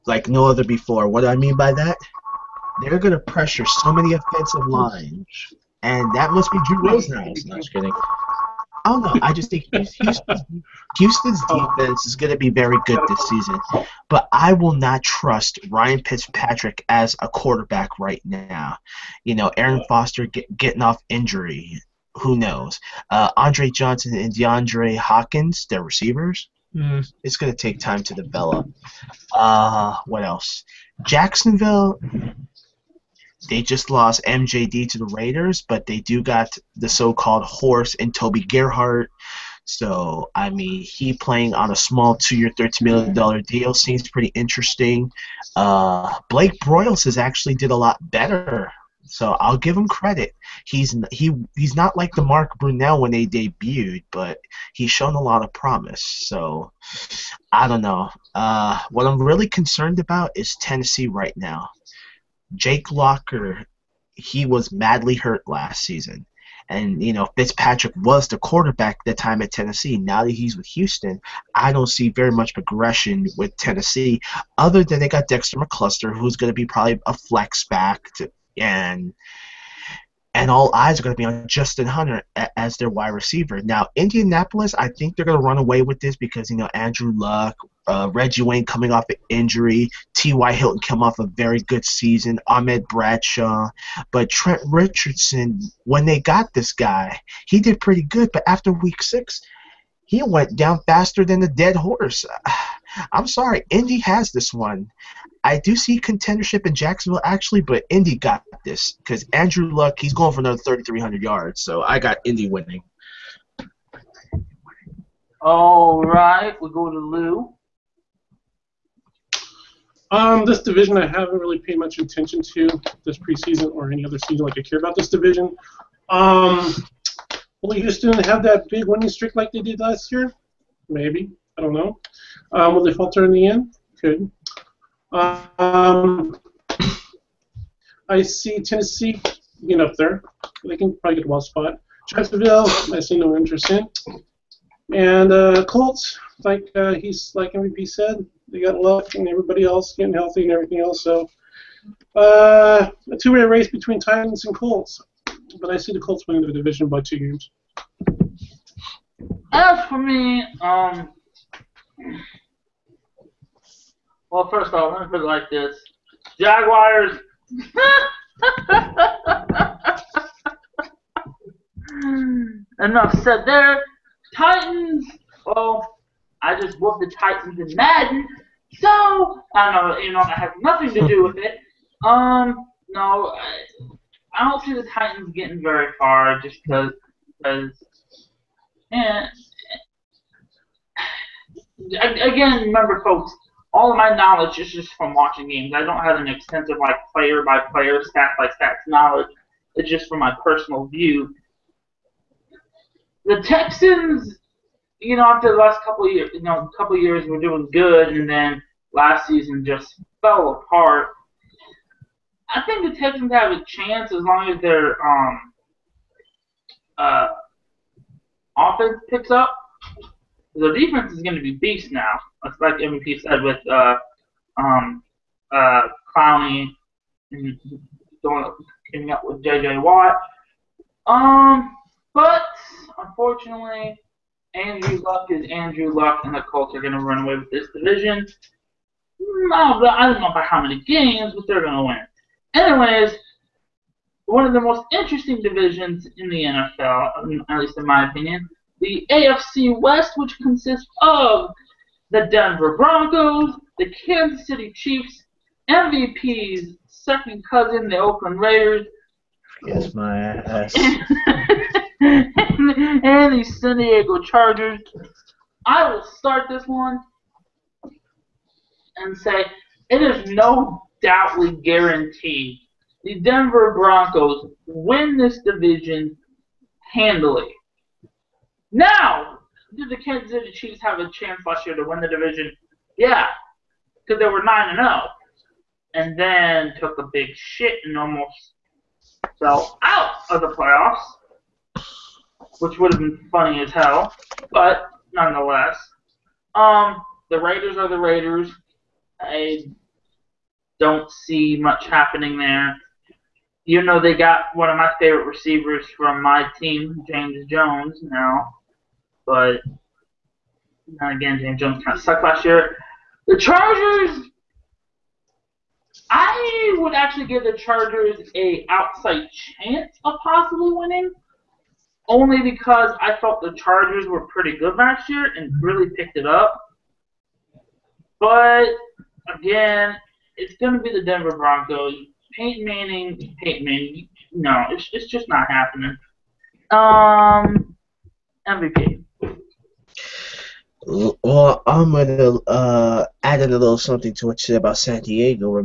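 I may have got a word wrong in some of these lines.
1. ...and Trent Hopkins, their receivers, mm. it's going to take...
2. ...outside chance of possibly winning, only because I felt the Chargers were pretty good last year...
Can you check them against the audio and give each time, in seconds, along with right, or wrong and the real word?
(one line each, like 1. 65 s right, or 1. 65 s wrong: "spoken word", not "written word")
1. 24 s wrong: "DeAndre", not "Trent"
2. 318 s right.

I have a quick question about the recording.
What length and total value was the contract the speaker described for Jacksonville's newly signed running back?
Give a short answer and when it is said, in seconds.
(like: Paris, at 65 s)
2-year, $13 million, at 42 s.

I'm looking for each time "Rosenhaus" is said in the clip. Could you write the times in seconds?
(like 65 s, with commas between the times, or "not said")
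6 s.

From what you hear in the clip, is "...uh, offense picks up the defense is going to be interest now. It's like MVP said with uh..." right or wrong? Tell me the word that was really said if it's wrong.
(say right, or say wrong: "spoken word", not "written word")
wrong: "beast", not "interest".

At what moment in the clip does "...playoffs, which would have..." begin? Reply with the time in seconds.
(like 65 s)
290 s.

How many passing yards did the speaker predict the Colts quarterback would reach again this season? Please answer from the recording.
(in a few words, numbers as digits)
3,300.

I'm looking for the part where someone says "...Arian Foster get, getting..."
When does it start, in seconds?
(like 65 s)
19 s.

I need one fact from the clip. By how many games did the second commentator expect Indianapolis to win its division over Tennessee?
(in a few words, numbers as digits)
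2.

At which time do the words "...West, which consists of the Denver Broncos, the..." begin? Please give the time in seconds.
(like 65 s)
249 s.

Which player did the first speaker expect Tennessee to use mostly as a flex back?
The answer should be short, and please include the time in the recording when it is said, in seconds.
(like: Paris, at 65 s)
Dexter McCluster, at 75 s.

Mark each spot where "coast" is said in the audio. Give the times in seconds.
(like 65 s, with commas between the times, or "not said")
not said.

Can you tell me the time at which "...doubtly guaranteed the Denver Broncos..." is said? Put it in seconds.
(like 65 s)
271 s.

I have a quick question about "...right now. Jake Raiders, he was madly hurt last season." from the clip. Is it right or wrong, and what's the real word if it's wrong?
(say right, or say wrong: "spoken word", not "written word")
wrong: "Locker", not "Raiders".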